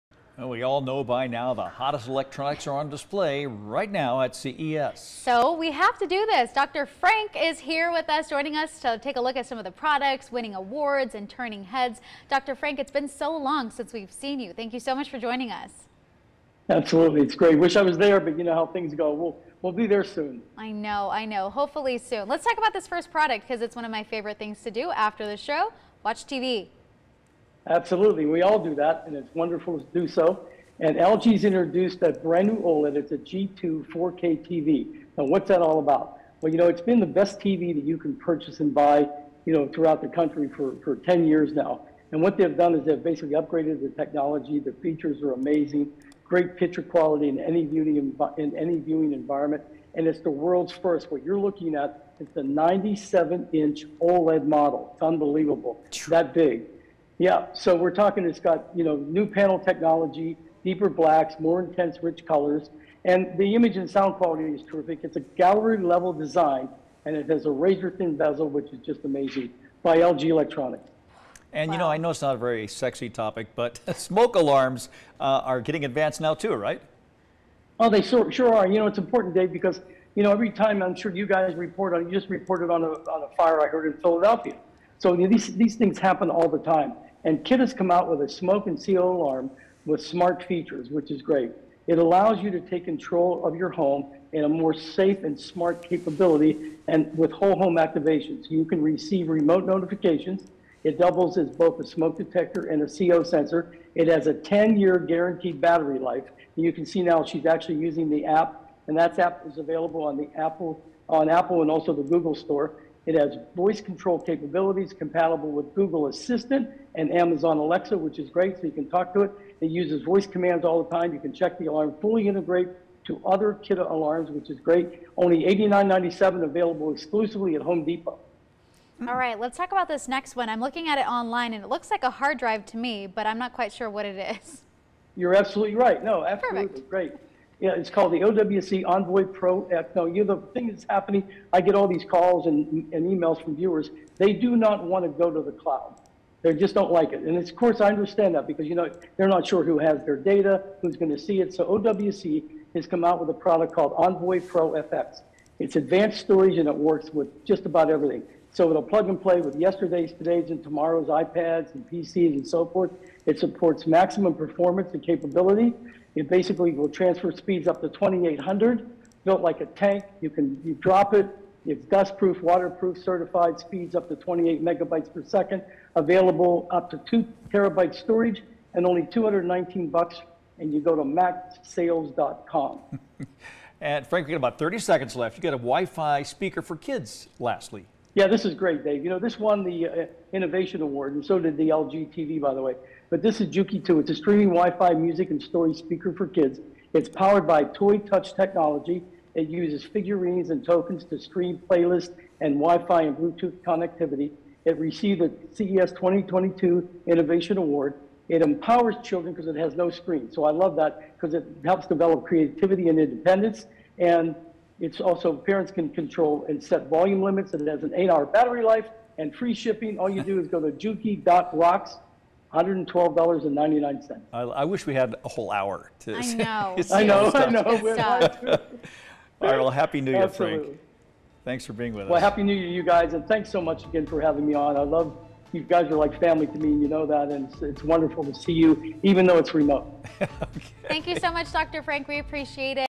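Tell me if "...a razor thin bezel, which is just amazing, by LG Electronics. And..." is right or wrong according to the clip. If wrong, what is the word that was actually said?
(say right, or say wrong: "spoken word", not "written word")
right.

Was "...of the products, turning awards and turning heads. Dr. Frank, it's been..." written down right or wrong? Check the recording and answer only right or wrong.
wrong.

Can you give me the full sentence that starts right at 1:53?
It has voice control capabilities compatible with Google Assistant and Amazon Alexa, which is great, so you can talk to it.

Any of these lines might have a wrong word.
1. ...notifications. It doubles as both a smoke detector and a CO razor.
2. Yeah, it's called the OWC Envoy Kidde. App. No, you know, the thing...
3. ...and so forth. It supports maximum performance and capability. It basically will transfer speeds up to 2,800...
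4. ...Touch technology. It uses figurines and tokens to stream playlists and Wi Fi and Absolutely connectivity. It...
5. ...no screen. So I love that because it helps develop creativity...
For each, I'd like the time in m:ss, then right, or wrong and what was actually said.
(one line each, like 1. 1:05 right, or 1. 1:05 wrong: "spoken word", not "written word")
1. 1:39 wrong: "sensor", not "razor"
2. 2:17 wrong: "Pro", not "Kidde"
3. 2:42 right
4. 3:17 wrong: "Bluetooth", not "Absolutely"
5. 3:29 right.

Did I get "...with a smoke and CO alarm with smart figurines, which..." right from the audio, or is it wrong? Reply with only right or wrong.
wrong.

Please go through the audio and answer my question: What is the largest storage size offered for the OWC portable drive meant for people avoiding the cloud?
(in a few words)
2 terabytes.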